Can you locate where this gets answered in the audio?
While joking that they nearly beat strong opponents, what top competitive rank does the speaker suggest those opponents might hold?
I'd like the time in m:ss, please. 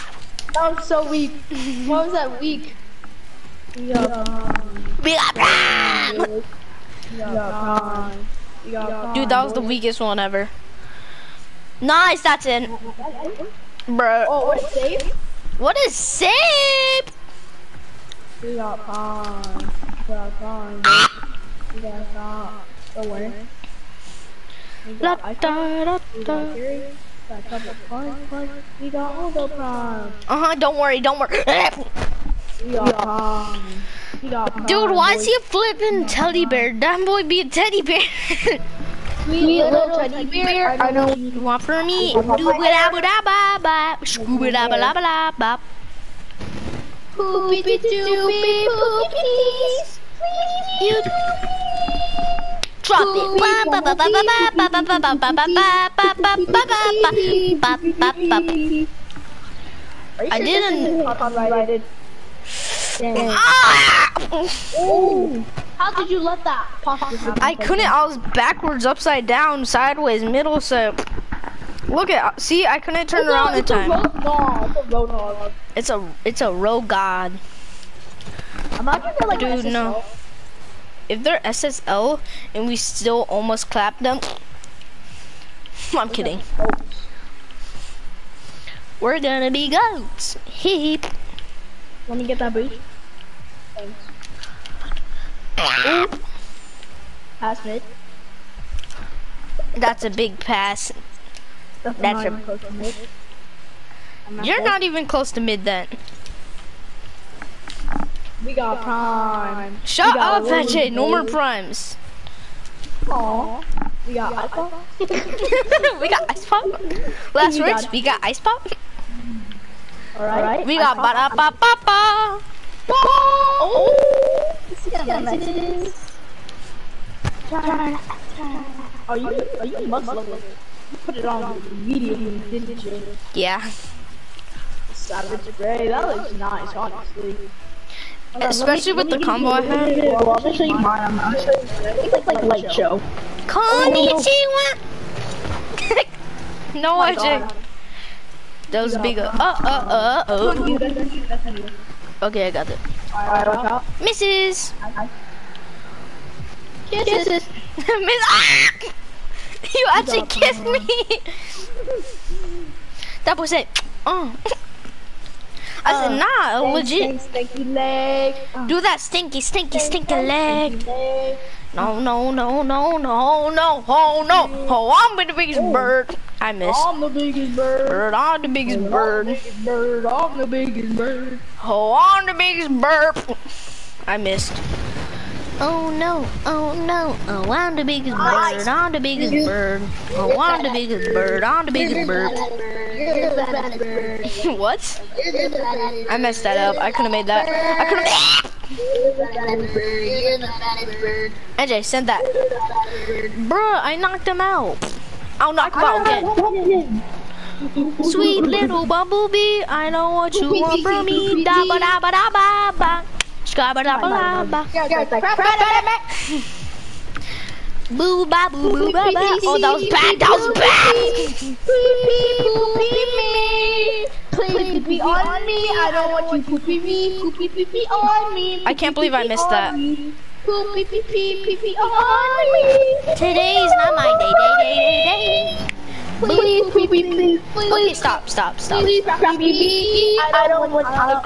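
1:21.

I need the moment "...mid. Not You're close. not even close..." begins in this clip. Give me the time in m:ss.
1:42.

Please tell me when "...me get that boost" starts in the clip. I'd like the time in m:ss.
1:32.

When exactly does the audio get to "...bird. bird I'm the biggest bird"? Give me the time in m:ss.
2:57.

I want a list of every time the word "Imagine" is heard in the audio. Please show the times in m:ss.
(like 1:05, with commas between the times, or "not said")
1:18.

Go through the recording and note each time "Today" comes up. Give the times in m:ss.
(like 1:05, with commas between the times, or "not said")
3:53.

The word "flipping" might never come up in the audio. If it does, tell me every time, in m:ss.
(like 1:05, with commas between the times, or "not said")
0:35.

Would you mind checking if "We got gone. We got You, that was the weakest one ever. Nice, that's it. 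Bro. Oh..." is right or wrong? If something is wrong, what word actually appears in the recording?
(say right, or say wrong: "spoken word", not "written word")
wrong: "Dude", not "You".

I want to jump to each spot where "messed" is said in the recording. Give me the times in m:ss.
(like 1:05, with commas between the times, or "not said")
3:16.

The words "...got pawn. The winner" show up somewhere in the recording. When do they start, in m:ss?
0:21.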